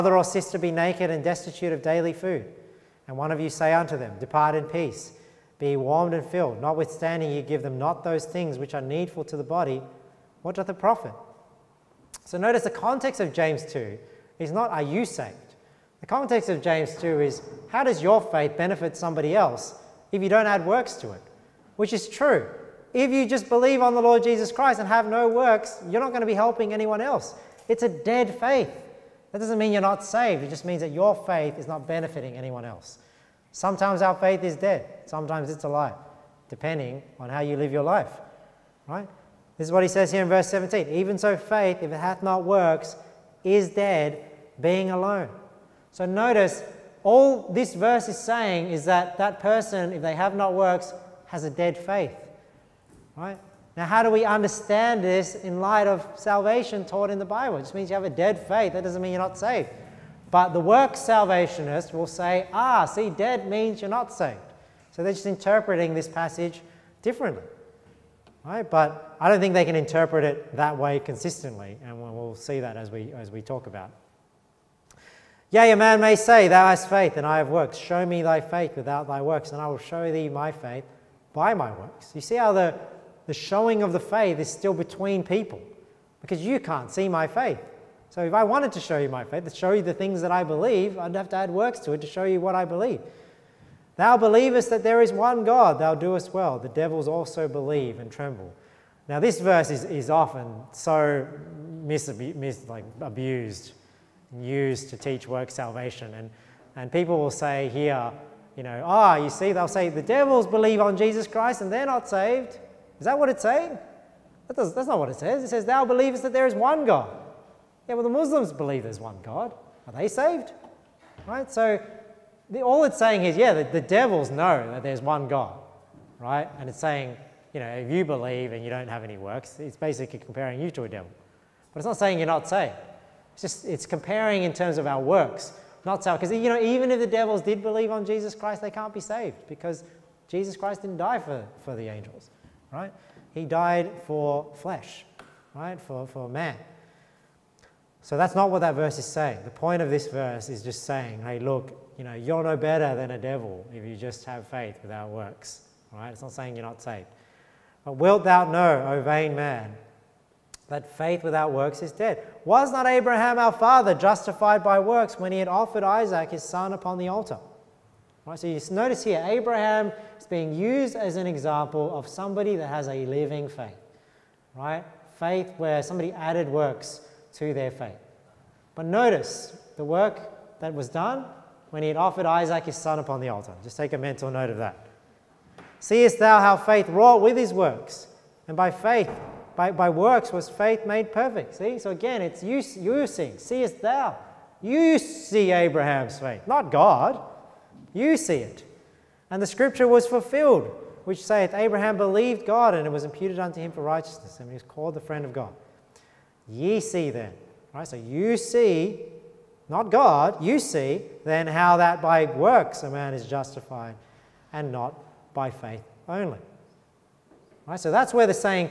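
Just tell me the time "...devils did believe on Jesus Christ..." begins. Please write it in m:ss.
2:17.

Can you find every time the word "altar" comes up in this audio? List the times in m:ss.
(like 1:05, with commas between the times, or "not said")
2:47, 3:03.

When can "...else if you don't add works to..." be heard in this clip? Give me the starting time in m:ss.
0:19.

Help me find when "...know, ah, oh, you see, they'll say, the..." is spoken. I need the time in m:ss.
1:48.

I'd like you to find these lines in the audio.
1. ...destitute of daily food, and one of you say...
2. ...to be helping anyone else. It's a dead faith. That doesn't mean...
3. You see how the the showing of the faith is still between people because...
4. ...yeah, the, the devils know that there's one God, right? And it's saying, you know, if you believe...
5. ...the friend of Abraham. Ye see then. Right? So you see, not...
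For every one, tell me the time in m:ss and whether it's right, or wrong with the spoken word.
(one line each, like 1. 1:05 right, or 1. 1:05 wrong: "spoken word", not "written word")
1. 0:01 right
2. 0:26 right
3. 1:22 right
4. 2:03 right
5. 3:24 wrong: "God", not "Abraham".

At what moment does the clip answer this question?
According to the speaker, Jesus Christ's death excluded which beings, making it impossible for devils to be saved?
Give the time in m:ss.
2:21.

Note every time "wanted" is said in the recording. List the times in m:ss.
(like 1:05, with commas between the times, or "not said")
1:28.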